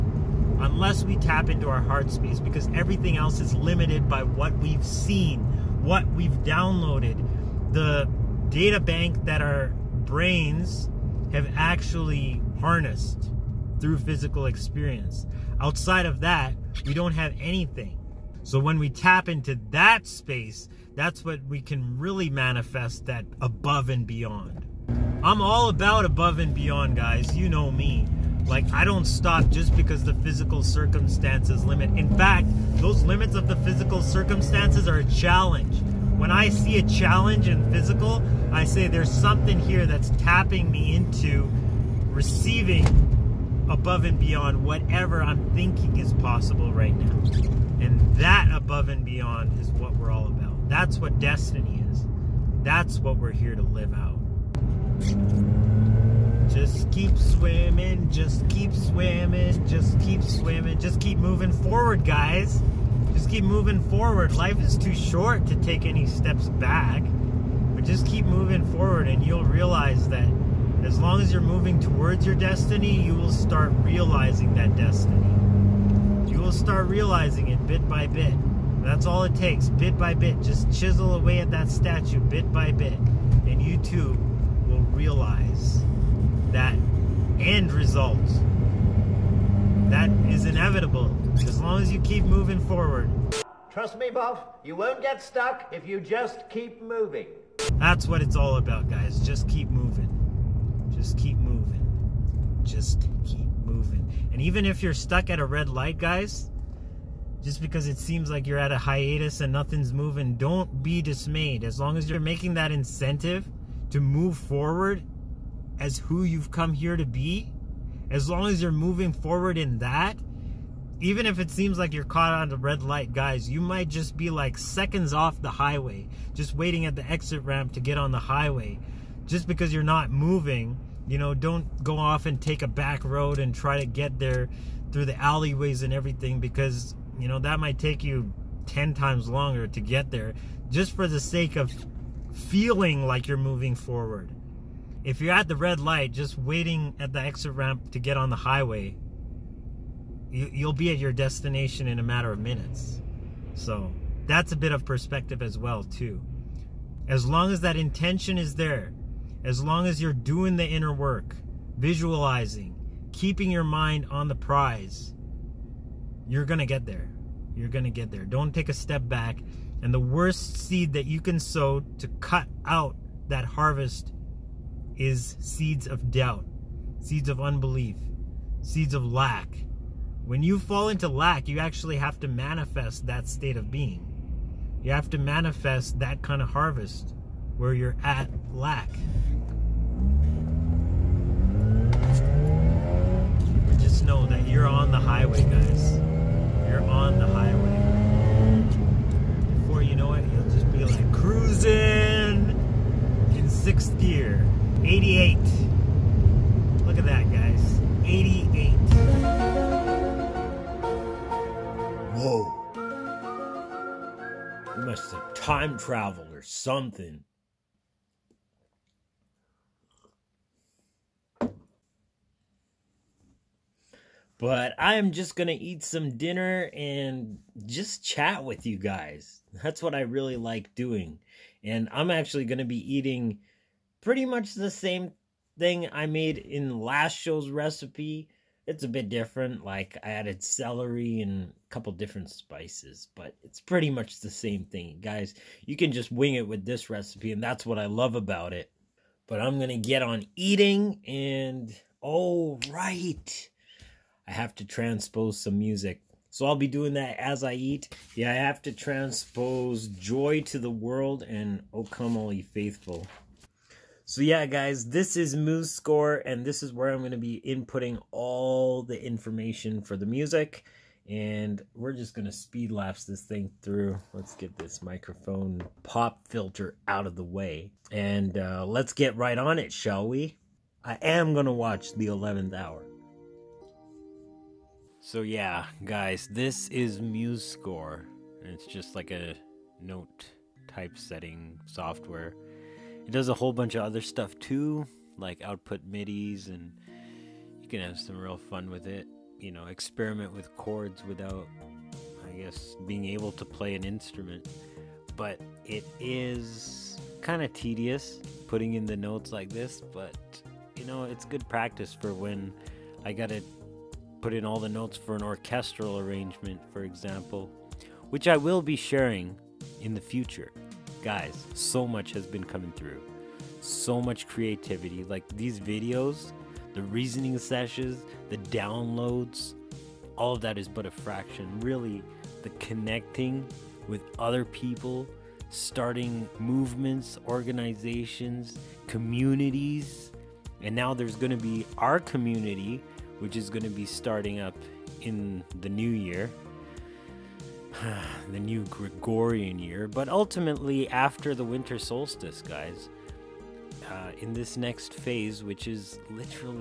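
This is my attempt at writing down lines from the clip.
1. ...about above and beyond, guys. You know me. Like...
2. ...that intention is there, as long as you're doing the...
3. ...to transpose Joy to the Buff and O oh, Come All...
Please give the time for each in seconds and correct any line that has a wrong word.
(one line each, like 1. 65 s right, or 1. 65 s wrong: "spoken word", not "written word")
1. 25 s right
2. 157 s right
3. 258 s wrong: "World", not "Buff".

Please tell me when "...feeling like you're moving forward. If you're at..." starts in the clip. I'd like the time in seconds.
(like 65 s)
142 s.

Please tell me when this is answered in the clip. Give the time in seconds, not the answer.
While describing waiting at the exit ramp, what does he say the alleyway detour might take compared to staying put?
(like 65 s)
138 s.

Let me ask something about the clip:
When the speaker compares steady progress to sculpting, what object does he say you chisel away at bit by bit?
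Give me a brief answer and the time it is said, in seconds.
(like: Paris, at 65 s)
statue, at 81 s.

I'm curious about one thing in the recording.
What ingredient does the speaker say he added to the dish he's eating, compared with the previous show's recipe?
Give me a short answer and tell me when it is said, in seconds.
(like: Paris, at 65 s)
celery, at 240 s.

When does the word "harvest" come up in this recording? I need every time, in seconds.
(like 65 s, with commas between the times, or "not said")
173 s, 186 s.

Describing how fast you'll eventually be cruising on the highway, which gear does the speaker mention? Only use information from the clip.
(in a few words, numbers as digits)
sixth gear.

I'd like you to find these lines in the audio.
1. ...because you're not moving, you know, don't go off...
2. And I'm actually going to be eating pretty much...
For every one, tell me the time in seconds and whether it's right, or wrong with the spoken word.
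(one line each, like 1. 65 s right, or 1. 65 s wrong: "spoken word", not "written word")
1. 129 s right
2. 231 s right.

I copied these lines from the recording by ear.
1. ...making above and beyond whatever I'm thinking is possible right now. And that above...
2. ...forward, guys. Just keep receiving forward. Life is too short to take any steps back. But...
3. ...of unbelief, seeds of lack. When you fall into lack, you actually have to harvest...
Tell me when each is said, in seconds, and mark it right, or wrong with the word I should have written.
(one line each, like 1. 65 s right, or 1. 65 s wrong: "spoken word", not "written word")
1. 42 s wrong: "receiving", not "making"
2. 61 s wrong: "moving", not "receiving"
3. 177 s wrong: "manifest", not "harvest".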